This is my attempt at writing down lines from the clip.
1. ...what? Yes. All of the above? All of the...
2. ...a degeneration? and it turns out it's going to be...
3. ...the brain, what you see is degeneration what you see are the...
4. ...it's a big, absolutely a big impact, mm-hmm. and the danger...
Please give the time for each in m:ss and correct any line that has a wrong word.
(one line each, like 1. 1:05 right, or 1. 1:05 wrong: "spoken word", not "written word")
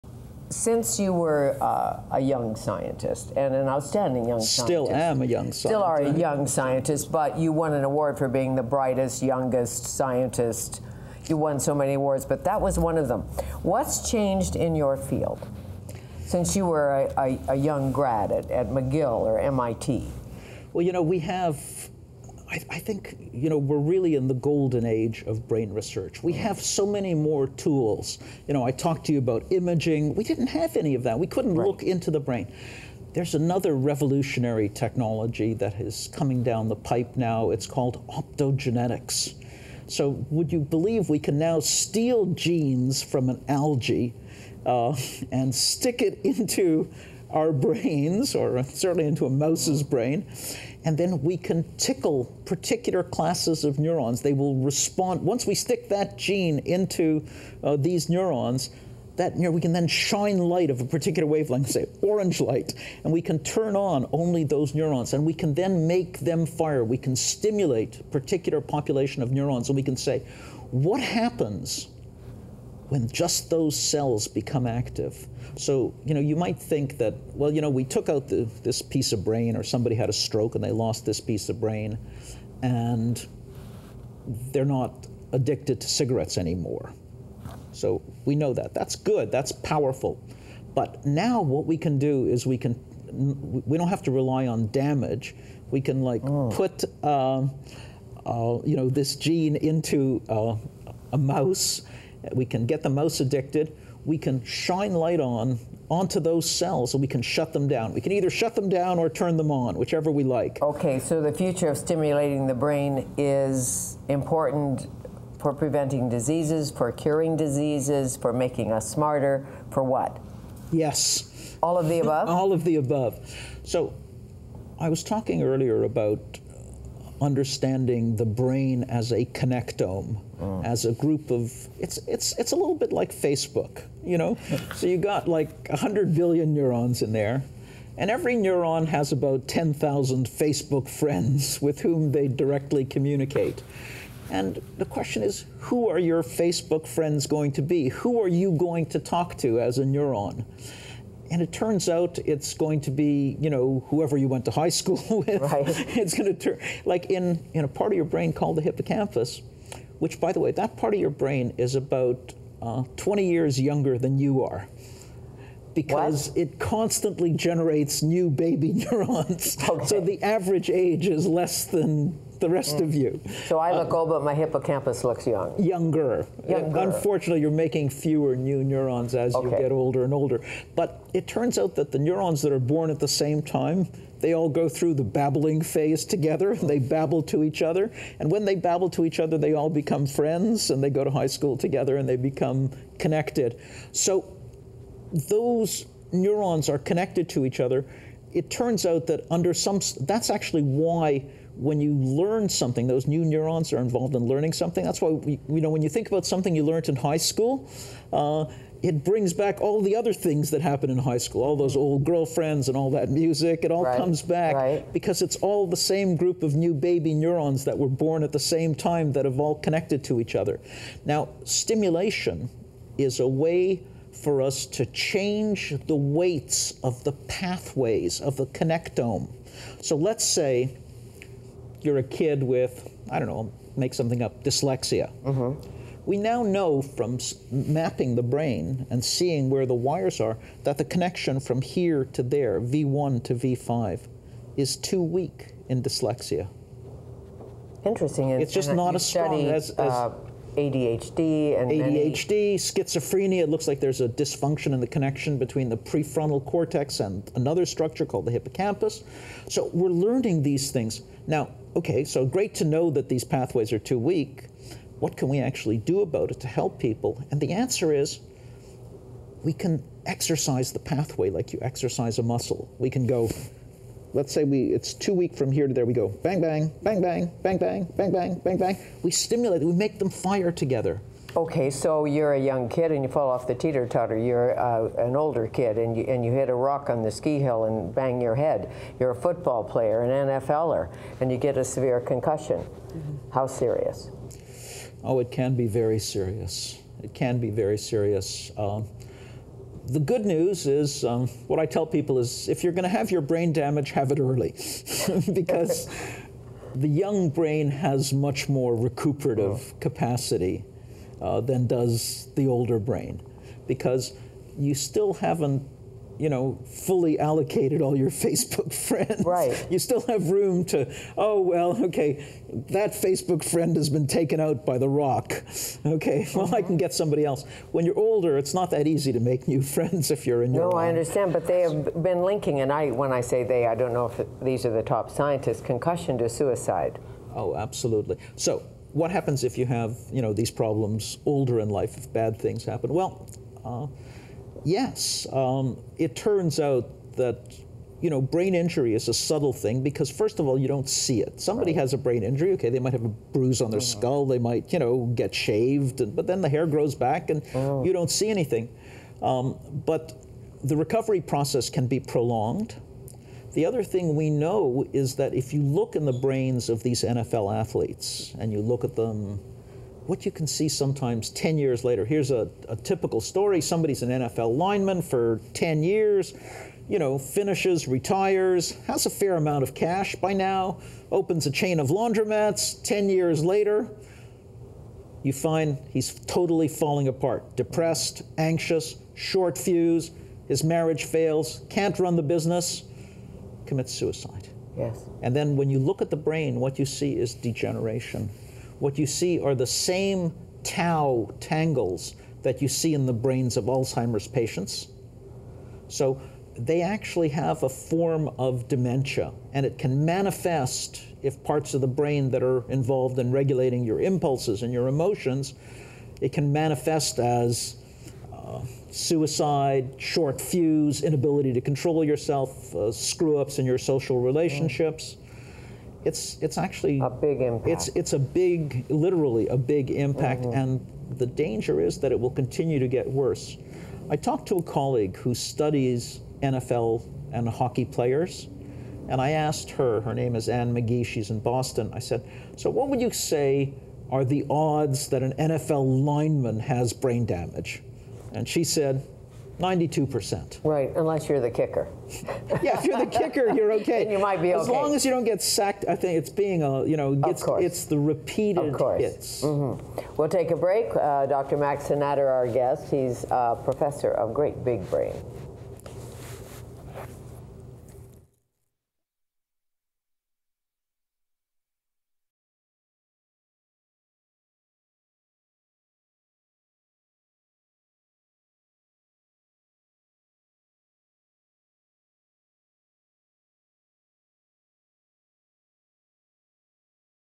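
1. 1:59 right
2. 2:29 wrong: "neuron", not "degeneration"
3. 6:36 right
4. 7:07 wrong: "literally", not "absolutely".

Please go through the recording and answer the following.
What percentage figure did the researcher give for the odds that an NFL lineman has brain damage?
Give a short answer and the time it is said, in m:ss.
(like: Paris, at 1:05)
92%, at 7:29.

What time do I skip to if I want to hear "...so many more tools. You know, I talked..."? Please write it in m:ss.
0:26.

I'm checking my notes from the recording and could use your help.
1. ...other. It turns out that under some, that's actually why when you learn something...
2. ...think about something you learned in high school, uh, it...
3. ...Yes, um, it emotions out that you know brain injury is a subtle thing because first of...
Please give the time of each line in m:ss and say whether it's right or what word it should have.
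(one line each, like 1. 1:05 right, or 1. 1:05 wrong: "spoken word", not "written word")
1. 3:17 right
2. 3:25 right
3. 5:44 wrong: "turns", not "emotions".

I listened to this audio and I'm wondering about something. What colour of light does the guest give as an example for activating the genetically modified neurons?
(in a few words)
orange.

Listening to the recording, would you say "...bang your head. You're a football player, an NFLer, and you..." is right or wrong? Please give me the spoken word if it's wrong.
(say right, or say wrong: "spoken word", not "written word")
right.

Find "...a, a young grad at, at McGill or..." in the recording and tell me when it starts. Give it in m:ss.
0:17.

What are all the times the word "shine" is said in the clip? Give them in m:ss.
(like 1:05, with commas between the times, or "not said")
0:59, 1:44.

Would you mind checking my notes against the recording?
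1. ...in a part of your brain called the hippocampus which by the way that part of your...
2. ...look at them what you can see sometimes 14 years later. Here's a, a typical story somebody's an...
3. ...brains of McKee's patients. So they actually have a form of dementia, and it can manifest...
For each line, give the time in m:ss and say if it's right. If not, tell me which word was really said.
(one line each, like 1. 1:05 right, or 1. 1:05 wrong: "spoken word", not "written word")
1. 2:37 right
2. 6:08 wrong: "10", not "14"
3. 6:43 wrong: "Alzheimer", not "McKee".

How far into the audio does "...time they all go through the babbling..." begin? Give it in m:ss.
3:03.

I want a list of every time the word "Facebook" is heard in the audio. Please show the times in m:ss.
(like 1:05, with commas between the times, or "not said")
2:13, 2:20, 2:26, 5:18, 5:22.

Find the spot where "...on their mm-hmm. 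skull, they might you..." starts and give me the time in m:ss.
5:53.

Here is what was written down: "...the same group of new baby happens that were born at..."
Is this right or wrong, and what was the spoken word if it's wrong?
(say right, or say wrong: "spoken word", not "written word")
wrong: "neurons", not "happens".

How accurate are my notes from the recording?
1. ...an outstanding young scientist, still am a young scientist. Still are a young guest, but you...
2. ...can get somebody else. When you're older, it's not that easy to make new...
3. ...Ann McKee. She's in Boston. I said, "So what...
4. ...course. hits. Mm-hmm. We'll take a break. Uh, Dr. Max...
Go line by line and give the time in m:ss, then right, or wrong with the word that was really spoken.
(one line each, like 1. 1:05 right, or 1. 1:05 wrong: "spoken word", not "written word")
1. 0:03 wrong: "scientist", not "guest"
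2. 5:26 right
3. 7:20 right
4. 7:38 right.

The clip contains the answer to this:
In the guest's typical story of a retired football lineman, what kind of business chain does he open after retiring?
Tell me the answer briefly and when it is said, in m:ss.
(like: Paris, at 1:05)
laundromats, at 6:21.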